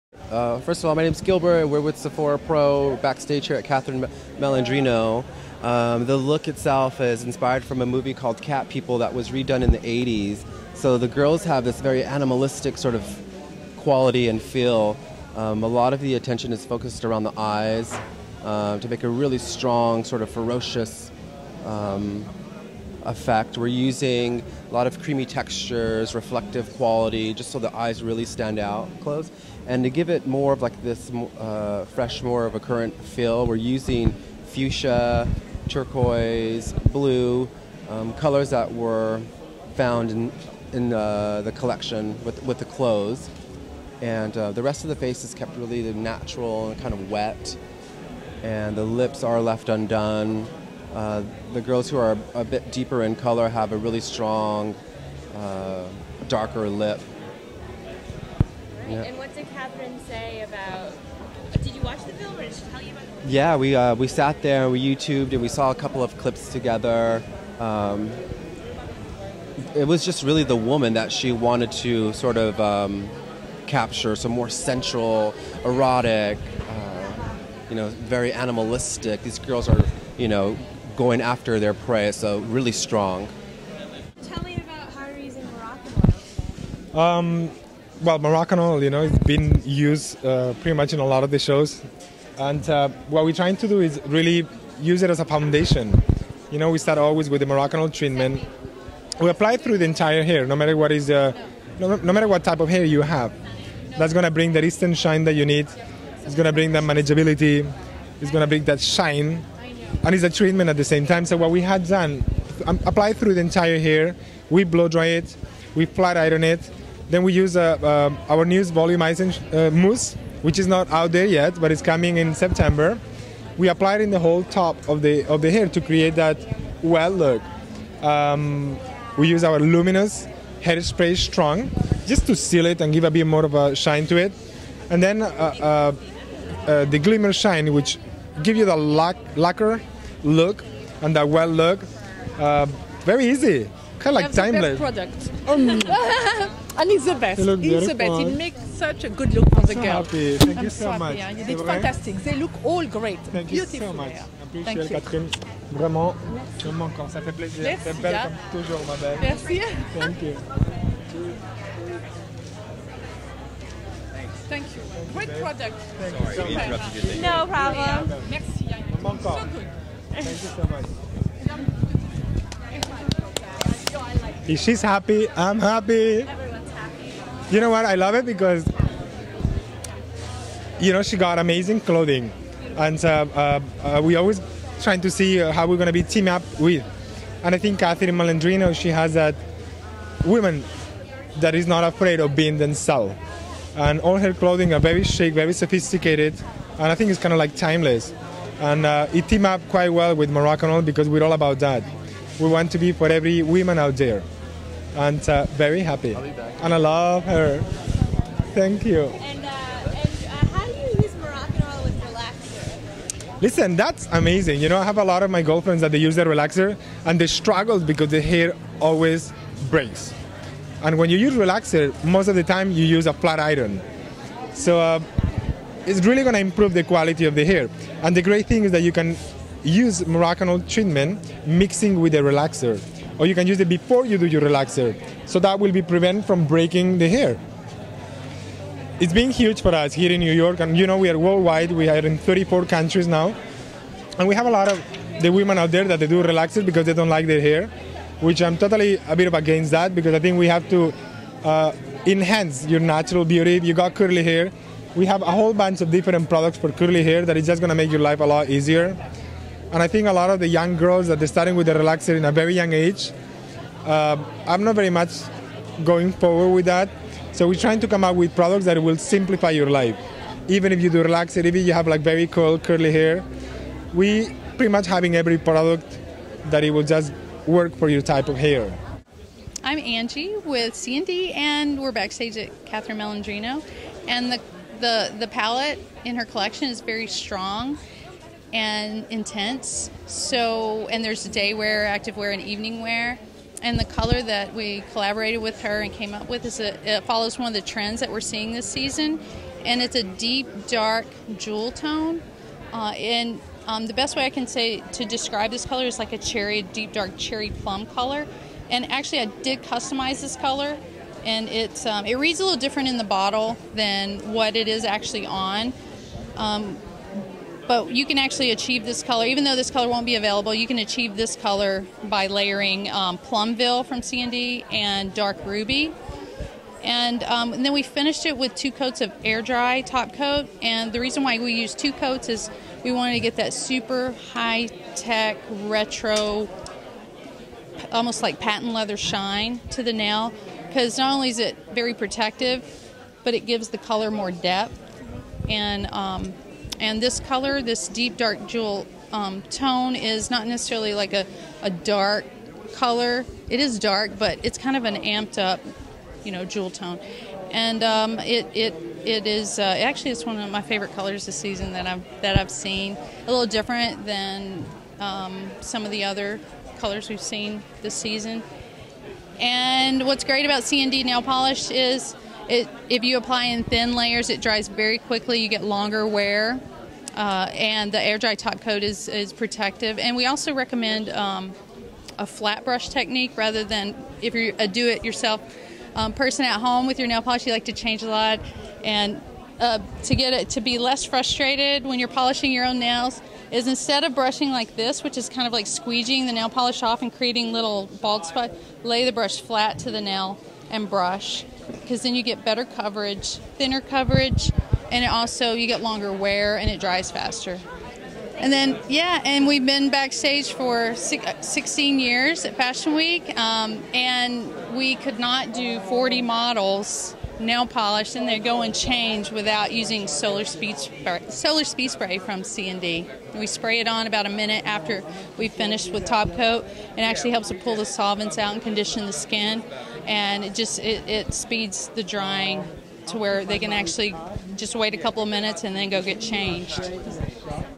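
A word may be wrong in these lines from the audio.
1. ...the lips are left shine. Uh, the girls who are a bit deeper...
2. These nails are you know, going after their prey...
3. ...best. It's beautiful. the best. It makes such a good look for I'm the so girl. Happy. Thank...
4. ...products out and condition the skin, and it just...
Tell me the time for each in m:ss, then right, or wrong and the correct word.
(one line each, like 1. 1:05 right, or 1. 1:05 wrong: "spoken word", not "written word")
1. 0:48 wrong: "undone", not "shine"
2. 1:19 wrong: "girls", not "nails"
3. 2:27 right
4. 7:07 wrong: "solvents", not "products".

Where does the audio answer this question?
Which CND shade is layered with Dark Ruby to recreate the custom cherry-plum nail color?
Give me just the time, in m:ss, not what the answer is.
5:23.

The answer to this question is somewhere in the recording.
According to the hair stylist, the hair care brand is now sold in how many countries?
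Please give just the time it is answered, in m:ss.
4:02.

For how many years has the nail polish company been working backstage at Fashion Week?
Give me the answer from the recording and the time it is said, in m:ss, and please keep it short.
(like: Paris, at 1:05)
16, at 6:50.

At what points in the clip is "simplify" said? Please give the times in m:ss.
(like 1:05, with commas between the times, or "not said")
4:28.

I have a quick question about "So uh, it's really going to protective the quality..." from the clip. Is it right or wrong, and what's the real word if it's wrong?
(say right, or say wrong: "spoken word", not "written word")
wrong: "improve", not "protective".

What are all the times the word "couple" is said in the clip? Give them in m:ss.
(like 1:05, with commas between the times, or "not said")
1:05, 7:14.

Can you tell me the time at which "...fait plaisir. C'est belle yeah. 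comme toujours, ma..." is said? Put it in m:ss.
2:37.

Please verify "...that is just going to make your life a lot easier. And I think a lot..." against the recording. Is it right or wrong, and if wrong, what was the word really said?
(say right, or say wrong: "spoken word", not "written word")
right.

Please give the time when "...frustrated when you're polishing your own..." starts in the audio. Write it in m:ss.
6:31.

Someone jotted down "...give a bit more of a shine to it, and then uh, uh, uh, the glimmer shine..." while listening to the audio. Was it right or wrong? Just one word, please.
right.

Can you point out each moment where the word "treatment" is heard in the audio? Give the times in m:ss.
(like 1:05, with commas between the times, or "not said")
1:37, 1:50, 3:50.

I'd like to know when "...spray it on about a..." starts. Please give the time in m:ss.
7:03.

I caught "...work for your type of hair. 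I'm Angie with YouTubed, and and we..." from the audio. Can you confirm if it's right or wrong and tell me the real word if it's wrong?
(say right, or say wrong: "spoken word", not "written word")
wrong: "CND", not "YouTubed".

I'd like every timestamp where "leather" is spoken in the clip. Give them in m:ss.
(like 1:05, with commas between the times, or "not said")
5:38.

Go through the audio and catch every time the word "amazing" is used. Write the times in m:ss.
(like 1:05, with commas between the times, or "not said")
3:01, 3:34.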